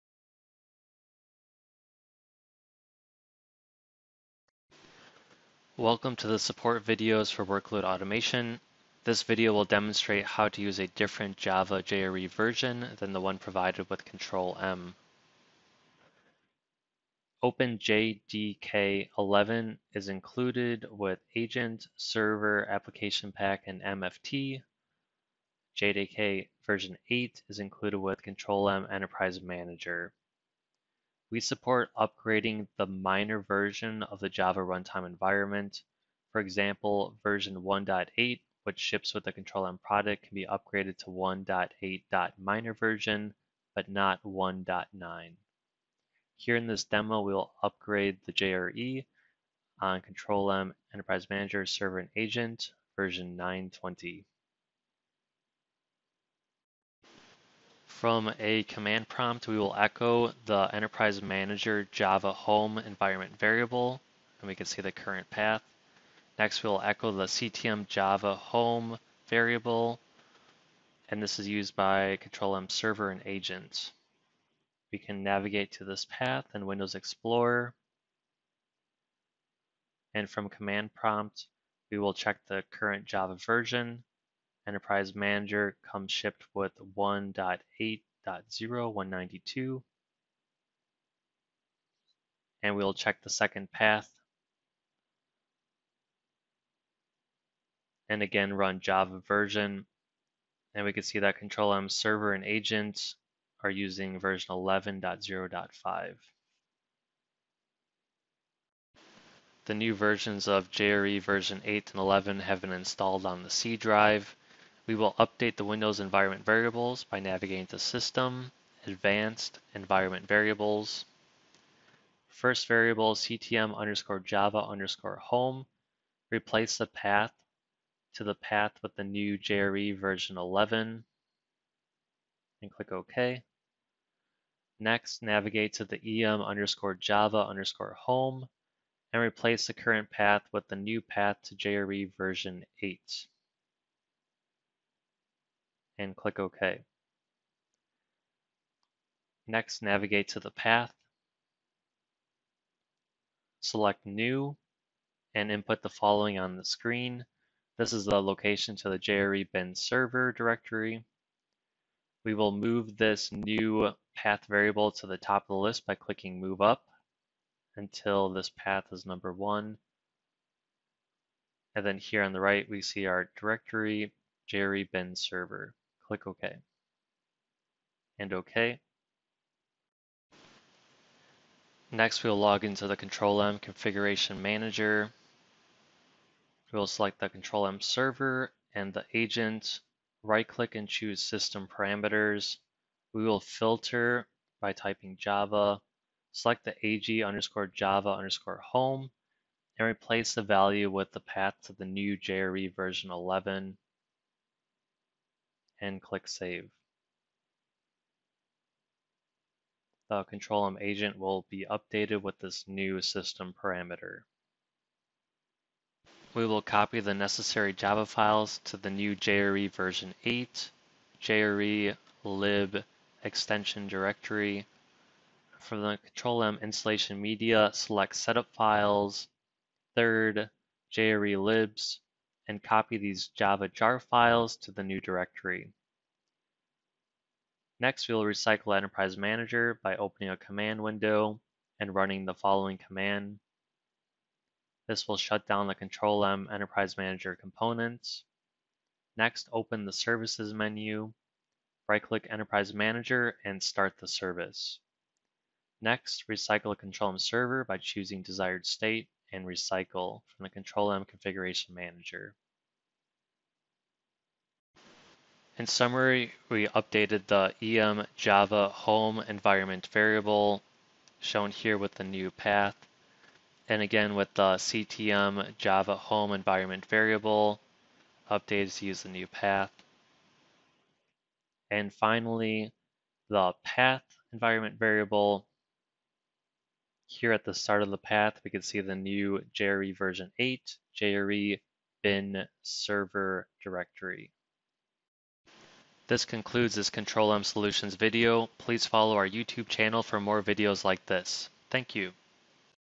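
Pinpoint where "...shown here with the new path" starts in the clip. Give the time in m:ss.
4:31.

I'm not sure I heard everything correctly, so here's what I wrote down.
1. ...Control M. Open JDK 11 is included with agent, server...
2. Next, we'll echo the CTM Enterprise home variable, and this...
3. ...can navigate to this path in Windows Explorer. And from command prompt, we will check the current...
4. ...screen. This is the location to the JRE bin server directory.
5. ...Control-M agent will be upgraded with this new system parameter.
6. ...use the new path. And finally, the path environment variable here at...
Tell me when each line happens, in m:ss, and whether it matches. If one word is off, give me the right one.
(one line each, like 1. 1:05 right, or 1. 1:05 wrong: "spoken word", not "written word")
1. 0:14 right
2. 1:06 wrong: "Java", not "Enterprise"
3. 1:14 right
4. 2:36 right
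5. 3:30 wrong: "updated", not "upgraded"
6. 4:38 right.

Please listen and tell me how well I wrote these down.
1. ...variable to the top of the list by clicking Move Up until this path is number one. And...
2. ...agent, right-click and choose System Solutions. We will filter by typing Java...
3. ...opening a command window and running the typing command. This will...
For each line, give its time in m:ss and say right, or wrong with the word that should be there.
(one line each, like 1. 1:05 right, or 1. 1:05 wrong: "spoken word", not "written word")
1. 2:44 right
2. 3:09 wrong: "Parameters", not "Solutions"
3. 3:59 wrong: "following", not "typing".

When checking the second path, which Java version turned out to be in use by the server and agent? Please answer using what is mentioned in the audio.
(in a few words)
11.0.5.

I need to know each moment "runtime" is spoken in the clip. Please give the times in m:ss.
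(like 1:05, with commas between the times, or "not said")
0:34.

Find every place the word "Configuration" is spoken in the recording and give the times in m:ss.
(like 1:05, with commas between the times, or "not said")
3:03, 4:21.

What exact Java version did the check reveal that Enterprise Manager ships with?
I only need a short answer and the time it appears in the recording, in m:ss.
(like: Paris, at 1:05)
1.8.0.192, at 1:26.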